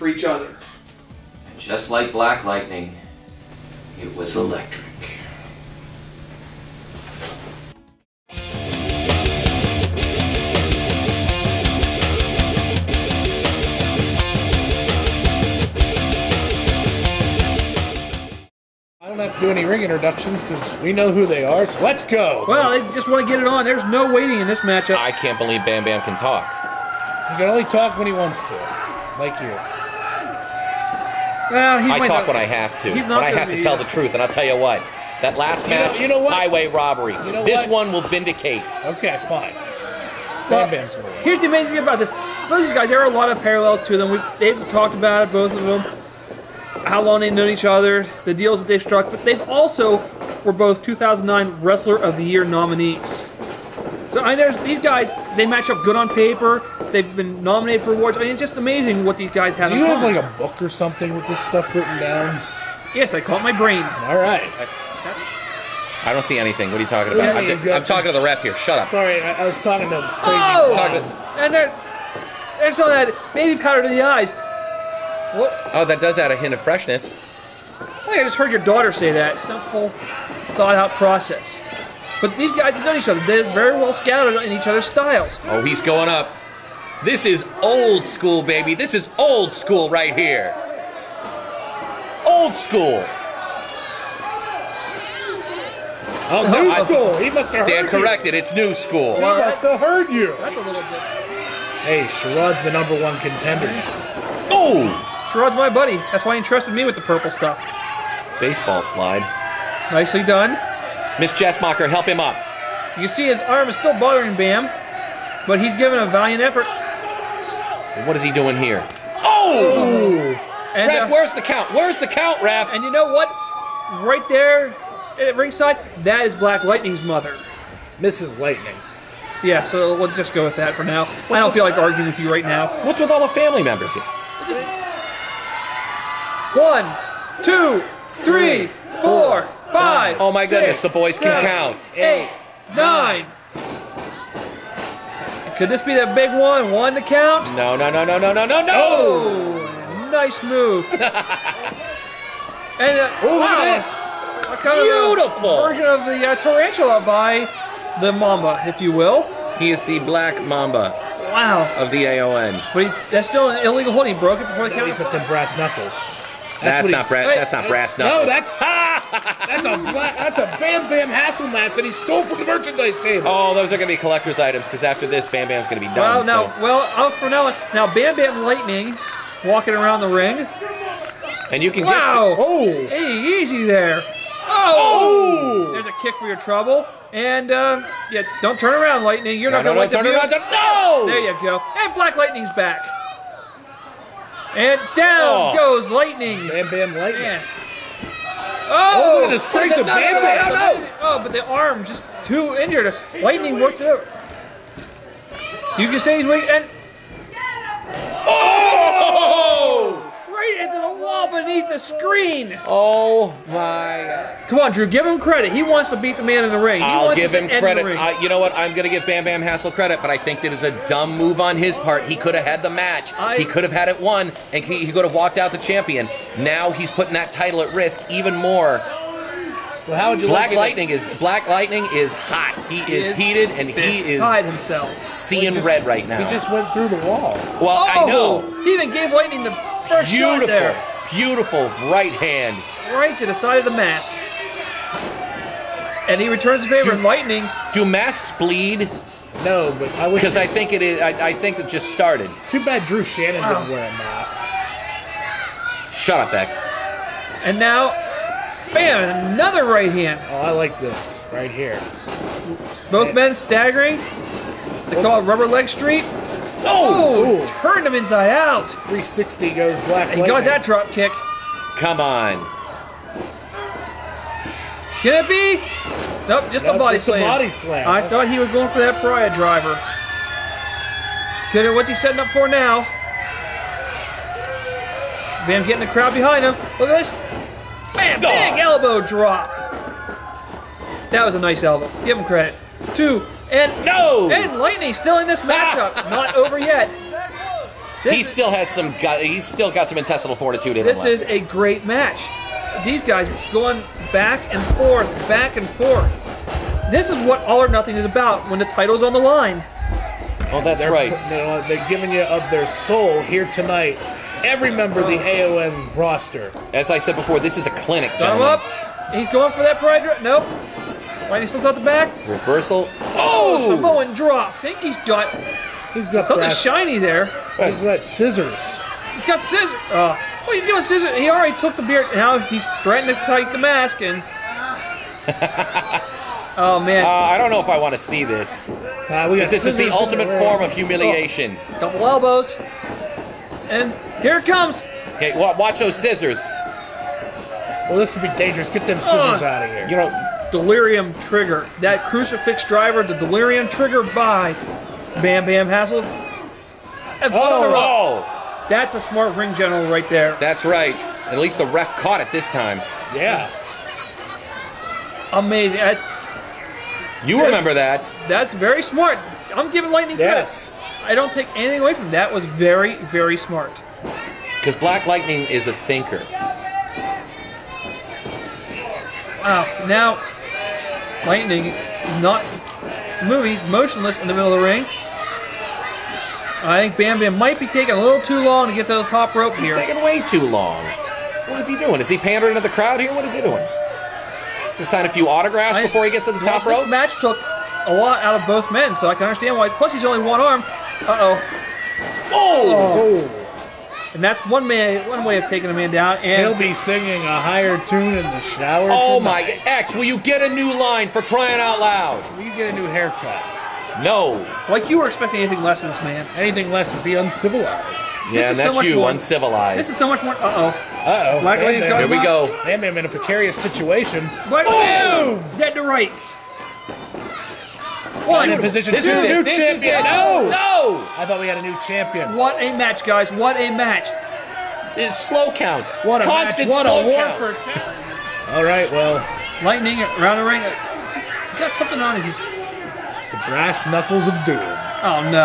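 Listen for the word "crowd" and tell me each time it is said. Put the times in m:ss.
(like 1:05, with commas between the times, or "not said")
4:45, 6:32.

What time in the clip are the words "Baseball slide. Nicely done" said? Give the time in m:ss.
1:48.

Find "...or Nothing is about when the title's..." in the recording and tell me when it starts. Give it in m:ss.
5:07.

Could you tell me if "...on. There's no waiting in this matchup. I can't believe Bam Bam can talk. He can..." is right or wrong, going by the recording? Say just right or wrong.
right.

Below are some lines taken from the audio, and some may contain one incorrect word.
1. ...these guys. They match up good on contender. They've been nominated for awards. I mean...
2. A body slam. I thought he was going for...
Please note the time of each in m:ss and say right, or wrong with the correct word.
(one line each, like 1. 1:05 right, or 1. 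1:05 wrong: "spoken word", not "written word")
1. 0:54 wrong: "paper", not "contender"
2. 4:37 right.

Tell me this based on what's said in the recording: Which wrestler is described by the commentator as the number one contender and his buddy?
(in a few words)
Sherrod.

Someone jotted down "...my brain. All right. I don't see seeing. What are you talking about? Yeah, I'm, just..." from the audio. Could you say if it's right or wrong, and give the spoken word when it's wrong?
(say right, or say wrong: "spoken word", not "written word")
wrong: "anything", not "seeing".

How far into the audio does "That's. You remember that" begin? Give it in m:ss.
6:05.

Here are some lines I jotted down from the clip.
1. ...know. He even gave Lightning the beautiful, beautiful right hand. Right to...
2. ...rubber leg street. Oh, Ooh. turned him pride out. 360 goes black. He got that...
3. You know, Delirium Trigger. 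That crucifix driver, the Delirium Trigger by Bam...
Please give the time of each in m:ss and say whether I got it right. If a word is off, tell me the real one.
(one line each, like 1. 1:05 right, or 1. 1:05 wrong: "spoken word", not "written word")
1. 3:58 right
2. 4:25 wrong: "inside", not "pride"
3. 5:49 right.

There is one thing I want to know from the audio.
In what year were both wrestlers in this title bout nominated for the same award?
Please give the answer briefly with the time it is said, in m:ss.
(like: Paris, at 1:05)
2009, at 0:50.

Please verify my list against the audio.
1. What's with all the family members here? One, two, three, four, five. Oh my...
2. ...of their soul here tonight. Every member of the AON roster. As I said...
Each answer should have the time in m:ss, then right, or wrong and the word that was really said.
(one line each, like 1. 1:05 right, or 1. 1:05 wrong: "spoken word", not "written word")
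1. 2:12 right
2. 5:12 right.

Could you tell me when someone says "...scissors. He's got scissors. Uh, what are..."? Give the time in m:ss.
5:28.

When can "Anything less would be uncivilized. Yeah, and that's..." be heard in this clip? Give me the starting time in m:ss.
6:56.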